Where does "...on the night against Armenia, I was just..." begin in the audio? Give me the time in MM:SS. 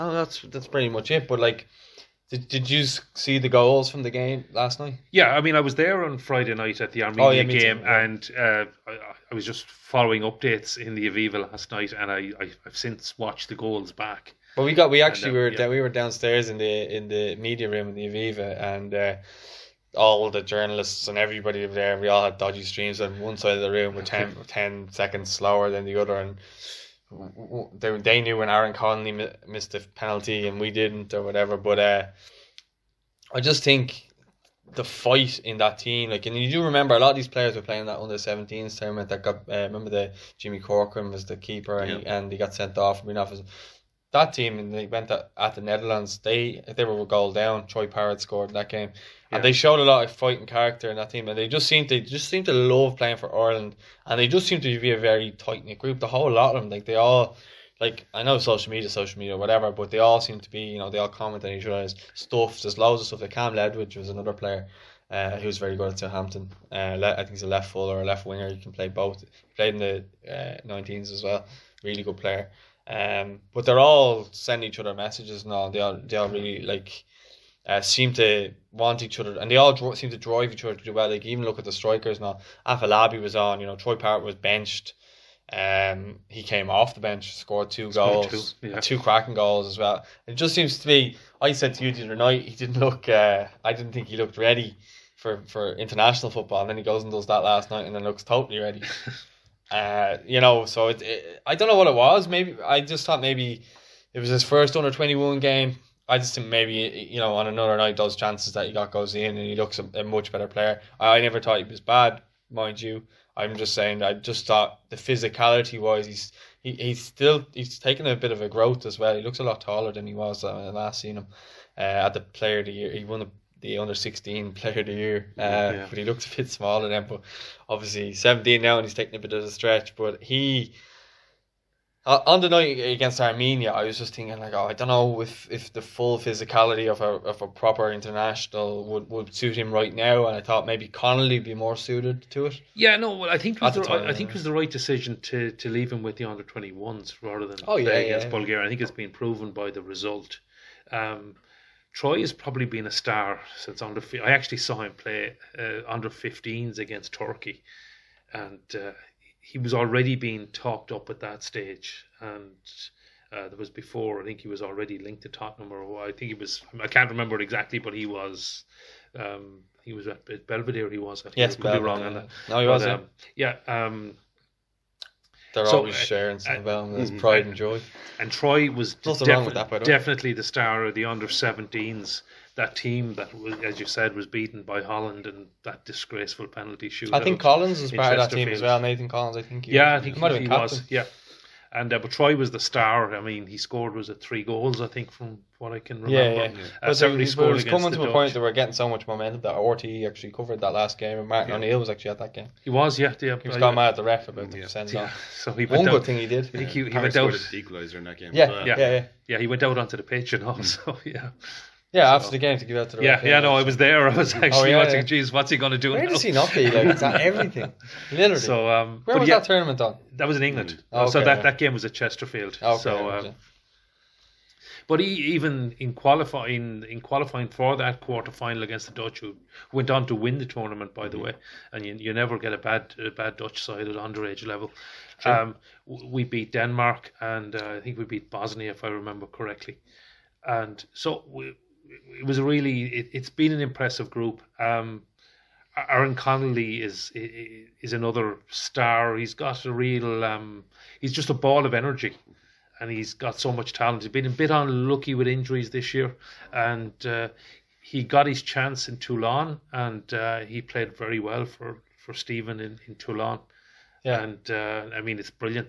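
02:12.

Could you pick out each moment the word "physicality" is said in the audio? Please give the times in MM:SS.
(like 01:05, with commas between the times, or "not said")
01:54, 02:16.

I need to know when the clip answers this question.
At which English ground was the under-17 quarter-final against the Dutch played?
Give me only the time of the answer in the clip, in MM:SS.
03:41.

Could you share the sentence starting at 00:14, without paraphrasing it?
But we got we actually and, uh, were yeah.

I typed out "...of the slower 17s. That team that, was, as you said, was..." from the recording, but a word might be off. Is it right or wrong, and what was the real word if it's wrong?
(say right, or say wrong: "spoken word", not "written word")
wrong: "under", not "slower".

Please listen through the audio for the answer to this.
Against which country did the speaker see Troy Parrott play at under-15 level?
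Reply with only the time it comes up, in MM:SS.
02:37.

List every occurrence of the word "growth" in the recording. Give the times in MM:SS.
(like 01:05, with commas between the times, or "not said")
01:58.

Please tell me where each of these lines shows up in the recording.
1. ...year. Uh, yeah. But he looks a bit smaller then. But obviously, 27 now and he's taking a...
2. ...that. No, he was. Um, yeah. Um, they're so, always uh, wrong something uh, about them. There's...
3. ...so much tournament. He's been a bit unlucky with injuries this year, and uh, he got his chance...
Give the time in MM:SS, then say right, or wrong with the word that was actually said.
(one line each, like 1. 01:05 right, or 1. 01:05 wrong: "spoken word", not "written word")
1. 02:04 wrong: "17", not "27"
2. 02:52 wrong: "sharing", not "wrong"
3. 04:13 wrong: "talent", not "tournament".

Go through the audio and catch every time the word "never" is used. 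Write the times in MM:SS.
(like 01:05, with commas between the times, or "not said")
01:51, 03:52.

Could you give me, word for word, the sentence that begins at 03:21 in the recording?
O'Neill was actually at that game.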